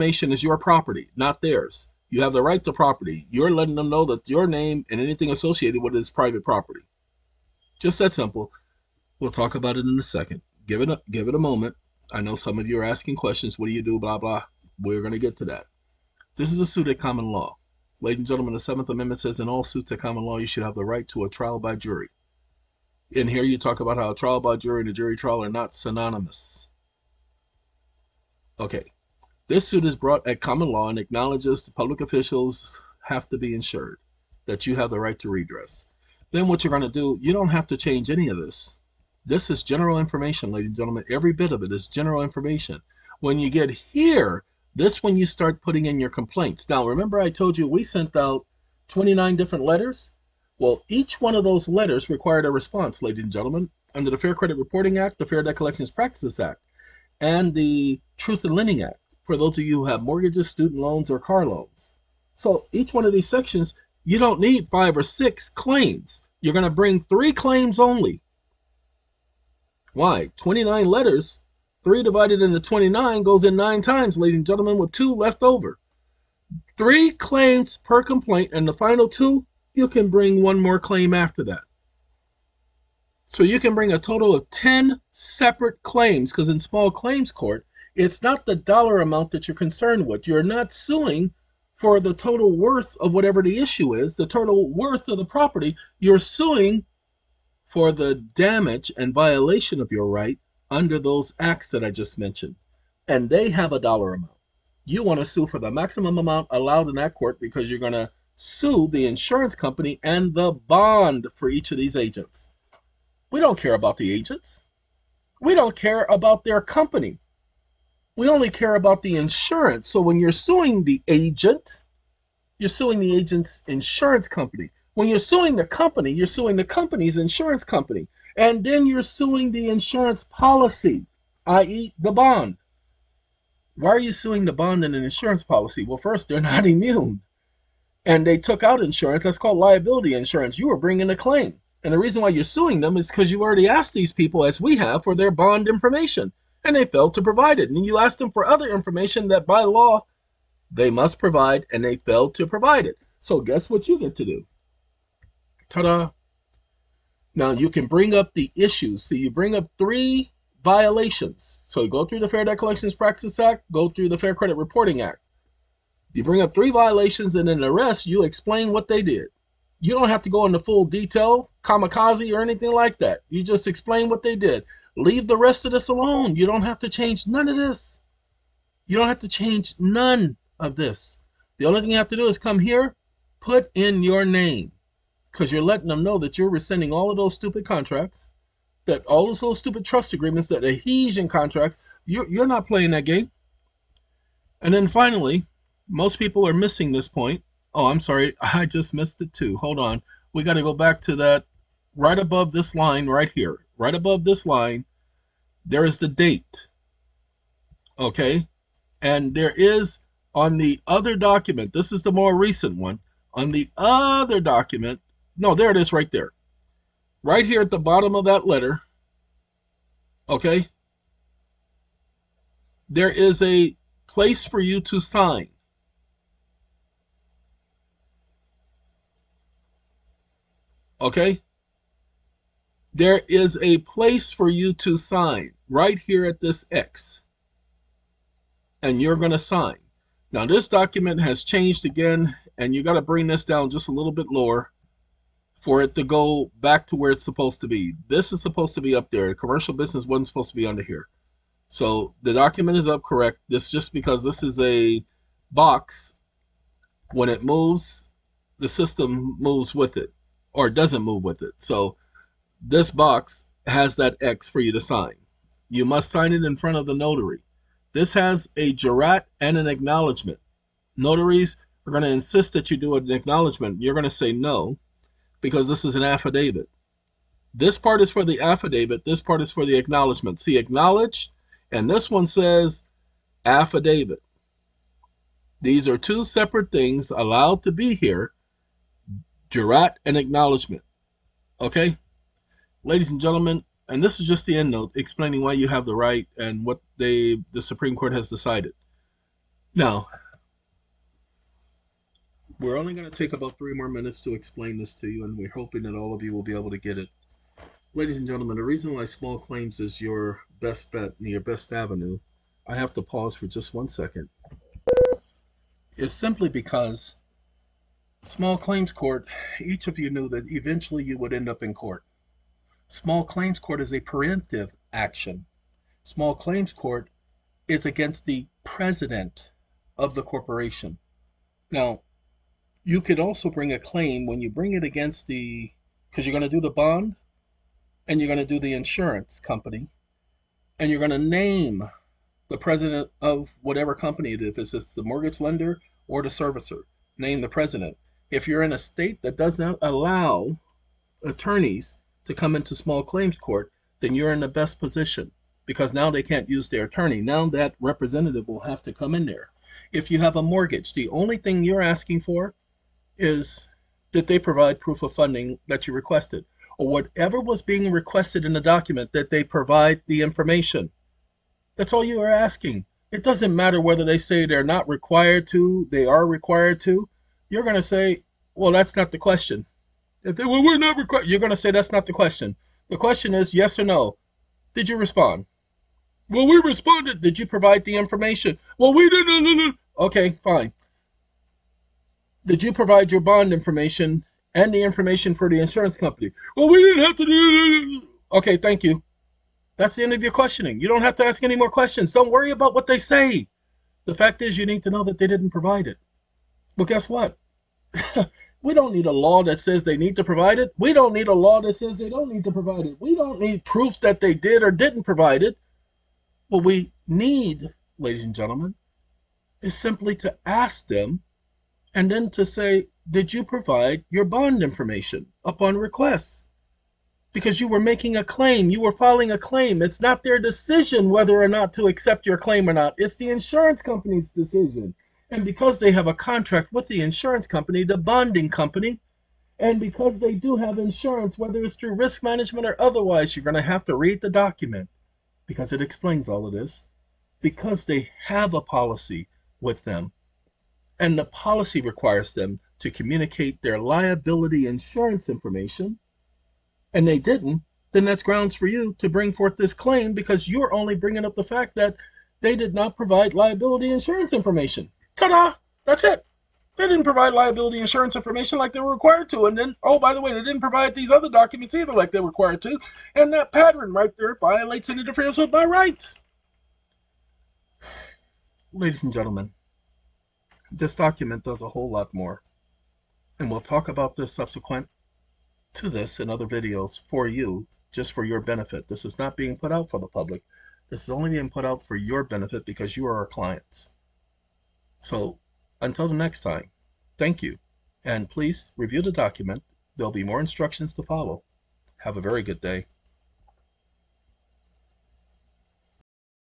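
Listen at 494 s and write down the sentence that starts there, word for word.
So until the next time, thank you.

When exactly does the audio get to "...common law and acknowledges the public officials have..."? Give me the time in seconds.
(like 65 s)
30 s.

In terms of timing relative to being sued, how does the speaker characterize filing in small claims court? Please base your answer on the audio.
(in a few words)
preemptive action.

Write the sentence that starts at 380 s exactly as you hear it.
If they, well, we're not required, you're going to say that's not the question.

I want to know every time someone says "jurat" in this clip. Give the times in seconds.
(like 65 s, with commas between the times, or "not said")
268 s, 289 s.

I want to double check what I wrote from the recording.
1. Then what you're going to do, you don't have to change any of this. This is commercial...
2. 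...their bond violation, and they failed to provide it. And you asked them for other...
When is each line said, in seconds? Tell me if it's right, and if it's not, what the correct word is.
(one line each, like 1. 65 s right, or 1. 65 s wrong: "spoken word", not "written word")
1. 36 s wrong: "general", not "commercial"
2. 145 s wrong: "information", not "violation".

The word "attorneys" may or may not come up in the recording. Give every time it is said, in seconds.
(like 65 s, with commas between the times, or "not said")
351 s, 356 s.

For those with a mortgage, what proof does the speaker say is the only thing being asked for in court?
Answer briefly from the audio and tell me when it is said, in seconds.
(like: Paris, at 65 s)
proof of funding, at 364 s.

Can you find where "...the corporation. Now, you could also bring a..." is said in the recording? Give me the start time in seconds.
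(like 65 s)
330 s.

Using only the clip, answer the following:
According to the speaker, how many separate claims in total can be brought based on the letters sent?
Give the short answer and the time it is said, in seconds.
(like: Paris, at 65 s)
10, at 84 s.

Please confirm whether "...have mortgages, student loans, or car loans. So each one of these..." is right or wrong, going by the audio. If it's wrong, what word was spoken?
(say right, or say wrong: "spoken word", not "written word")
right.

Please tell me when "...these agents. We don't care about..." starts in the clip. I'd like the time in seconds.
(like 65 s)
111 s.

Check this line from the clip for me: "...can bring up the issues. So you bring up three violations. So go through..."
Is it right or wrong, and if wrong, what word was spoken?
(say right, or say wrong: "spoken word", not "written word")
right.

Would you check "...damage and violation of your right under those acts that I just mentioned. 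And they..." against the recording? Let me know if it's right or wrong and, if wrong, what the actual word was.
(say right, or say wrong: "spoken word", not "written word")
right.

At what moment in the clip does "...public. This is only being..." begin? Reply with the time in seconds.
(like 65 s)
490 s.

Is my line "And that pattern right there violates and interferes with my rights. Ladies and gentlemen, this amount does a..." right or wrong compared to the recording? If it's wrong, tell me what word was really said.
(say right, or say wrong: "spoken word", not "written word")
wrong: "document", not "amount".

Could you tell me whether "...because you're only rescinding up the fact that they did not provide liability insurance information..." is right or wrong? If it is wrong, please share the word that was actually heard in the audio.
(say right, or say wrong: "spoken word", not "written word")
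wrong: "bringing", not "rescinding".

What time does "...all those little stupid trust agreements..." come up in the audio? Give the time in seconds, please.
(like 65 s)
189 s.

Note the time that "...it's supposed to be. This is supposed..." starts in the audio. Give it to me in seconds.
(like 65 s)
247 s.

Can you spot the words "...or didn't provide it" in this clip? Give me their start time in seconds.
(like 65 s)
414 s.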